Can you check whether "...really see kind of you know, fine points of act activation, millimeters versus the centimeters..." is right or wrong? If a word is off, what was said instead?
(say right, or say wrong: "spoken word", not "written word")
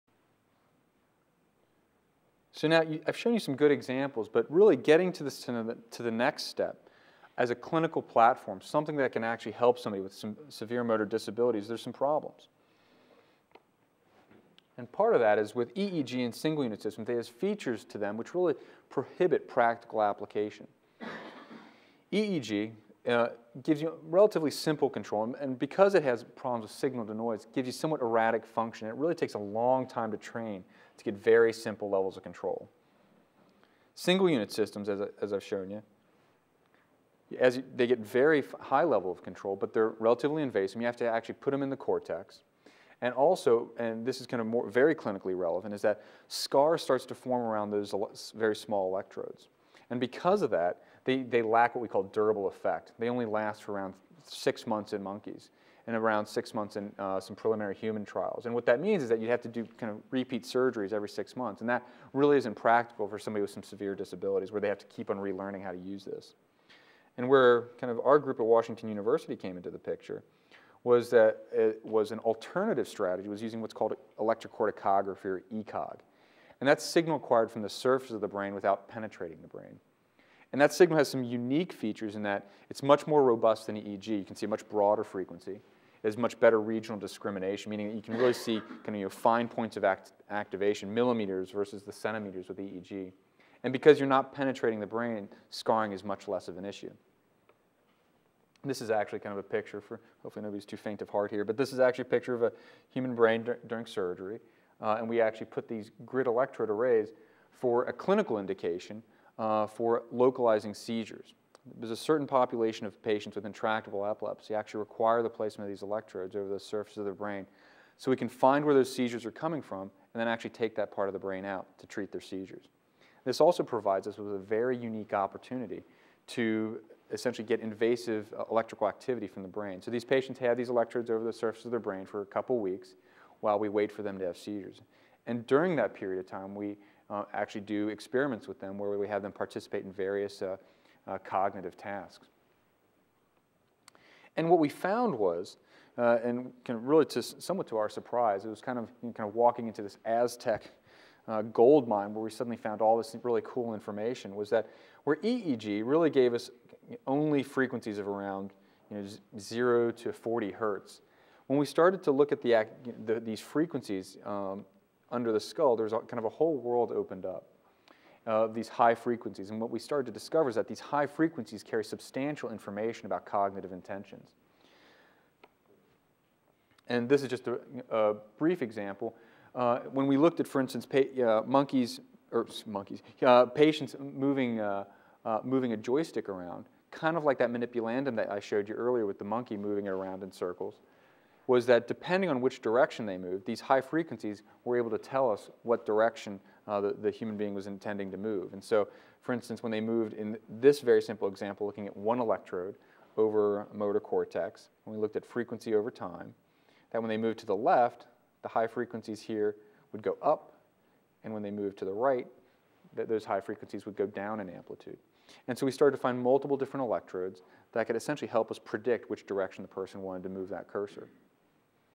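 right.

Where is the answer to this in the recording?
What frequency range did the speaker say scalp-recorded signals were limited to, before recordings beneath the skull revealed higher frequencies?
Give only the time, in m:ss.
2:39.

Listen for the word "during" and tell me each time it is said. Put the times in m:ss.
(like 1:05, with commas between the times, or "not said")
1:43, 2:15.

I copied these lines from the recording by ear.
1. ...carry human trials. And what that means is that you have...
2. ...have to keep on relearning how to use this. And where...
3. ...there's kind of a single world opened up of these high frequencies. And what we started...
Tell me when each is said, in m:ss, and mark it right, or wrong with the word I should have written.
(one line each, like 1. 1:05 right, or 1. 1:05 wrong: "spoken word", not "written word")
1. 0:57 wrong: "preliminary", not "carry"
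2. 1:04 right
3. 2:45 wrong: "whole", not "single".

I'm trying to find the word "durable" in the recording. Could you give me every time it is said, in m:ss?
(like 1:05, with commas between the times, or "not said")
0:52.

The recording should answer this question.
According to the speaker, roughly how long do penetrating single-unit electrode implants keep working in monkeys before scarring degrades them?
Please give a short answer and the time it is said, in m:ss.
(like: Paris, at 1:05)
6 months, at 0:54.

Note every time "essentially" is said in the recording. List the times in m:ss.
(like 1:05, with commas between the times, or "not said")
2:07, 3:37.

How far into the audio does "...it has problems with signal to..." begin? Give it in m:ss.
0:25.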